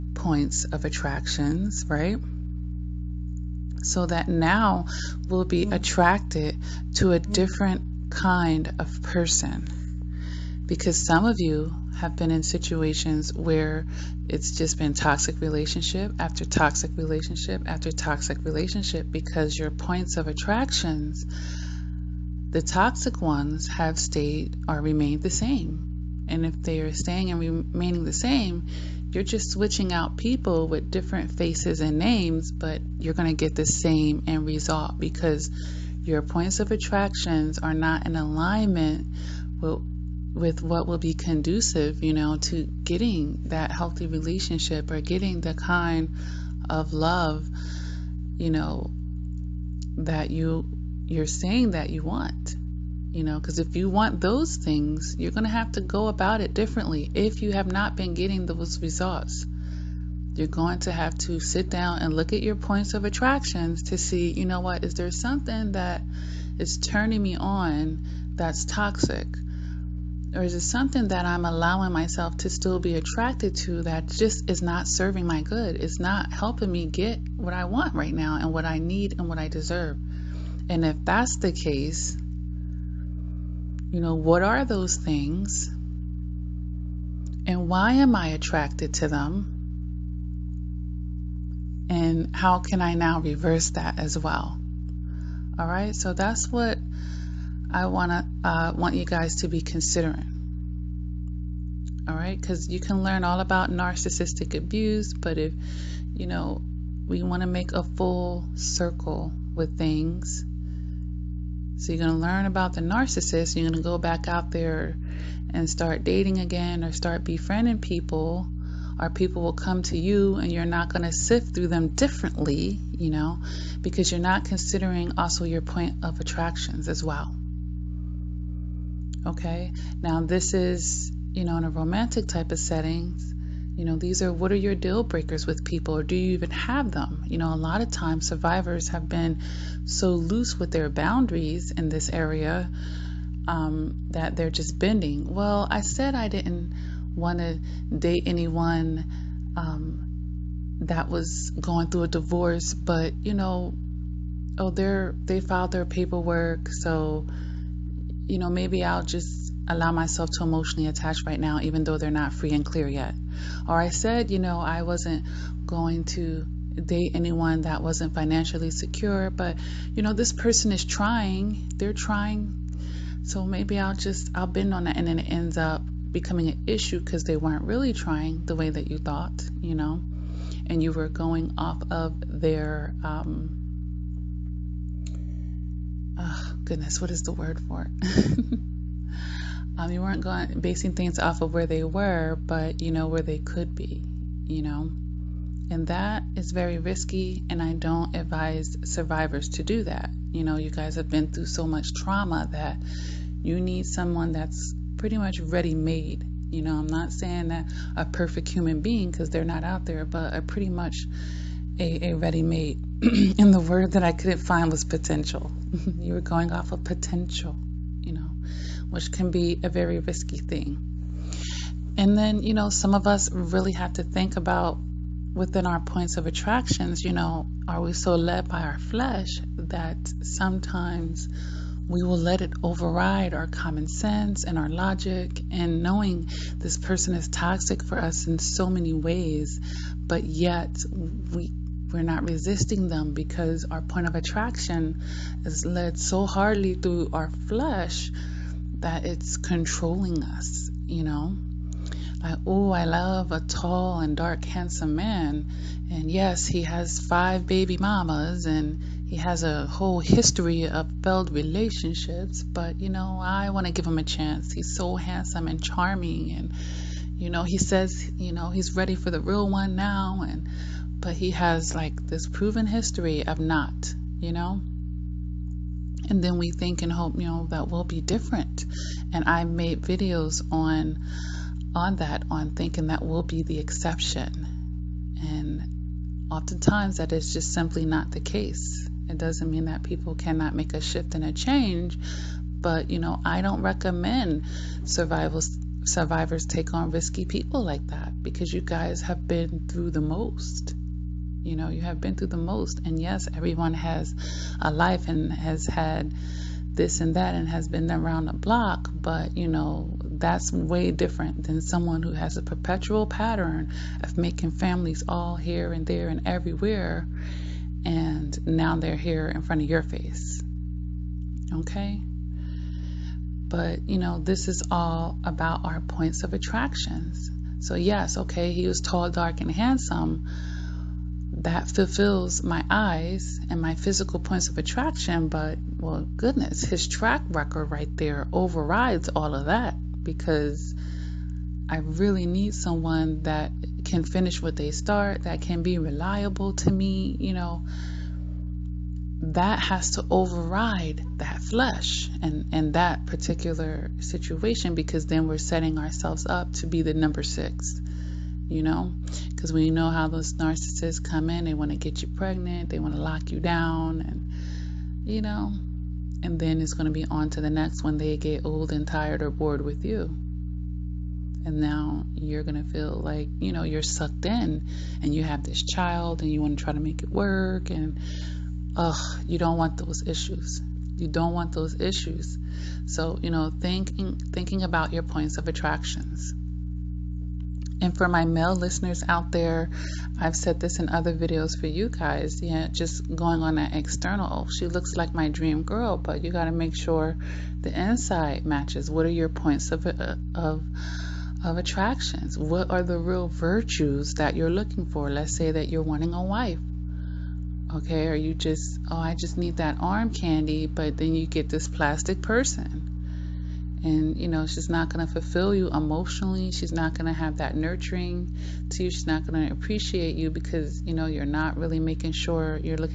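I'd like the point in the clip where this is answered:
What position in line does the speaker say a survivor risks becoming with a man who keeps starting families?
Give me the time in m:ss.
5:56.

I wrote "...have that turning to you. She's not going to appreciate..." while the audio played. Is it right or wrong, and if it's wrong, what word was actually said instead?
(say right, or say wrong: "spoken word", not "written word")
wrong: "nurturing", not "turning".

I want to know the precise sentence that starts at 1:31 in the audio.
And how can I now reverse that as well?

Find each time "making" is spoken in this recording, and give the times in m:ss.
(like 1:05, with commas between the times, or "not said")
5:14, 7:01.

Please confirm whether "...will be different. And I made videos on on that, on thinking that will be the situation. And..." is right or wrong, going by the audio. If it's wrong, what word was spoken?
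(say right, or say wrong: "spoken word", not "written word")
wrong: "exception", not "situation".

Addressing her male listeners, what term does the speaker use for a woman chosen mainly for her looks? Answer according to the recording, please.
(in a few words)
arm candy.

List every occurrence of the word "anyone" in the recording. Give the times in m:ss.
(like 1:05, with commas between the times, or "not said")
2:28, 2:47.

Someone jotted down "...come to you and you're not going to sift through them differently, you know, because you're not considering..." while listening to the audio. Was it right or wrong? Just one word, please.
right.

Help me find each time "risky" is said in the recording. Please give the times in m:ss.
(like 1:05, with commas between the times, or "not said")
3:16, 3:39, 4:56.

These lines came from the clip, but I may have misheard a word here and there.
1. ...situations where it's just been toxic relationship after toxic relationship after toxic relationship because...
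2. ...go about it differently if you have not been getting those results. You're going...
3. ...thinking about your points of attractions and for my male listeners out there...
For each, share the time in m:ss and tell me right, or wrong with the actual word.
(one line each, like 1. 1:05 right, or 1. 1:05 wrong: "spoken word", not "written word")
1. 0:12 right
2. 0:55 right
3. 6:24 right.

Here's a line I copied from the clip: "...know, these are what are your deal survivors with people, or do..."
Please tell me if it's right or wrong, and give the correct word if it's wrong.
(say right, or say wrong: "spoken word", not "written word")
wrong: "breakers", not "survivors".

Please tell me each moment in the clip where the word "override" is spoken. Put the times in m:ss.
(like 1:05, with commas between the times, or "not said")
3:52, 5:38, 5:50.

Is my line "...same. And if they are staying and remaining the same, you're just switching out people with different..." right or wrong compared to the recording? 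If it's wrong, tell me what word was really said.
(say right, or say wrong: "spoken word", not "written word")
right.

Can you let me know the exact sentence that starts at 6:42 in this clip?
What are the real virtues that you're looking for?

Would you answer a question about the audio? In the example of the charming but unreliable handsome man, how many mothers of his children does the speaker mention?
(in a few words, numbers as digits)
5.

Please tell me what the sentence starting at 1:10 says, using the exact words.
Or is it something that I'm allowing myself to still be attracted to that just is not serving my good?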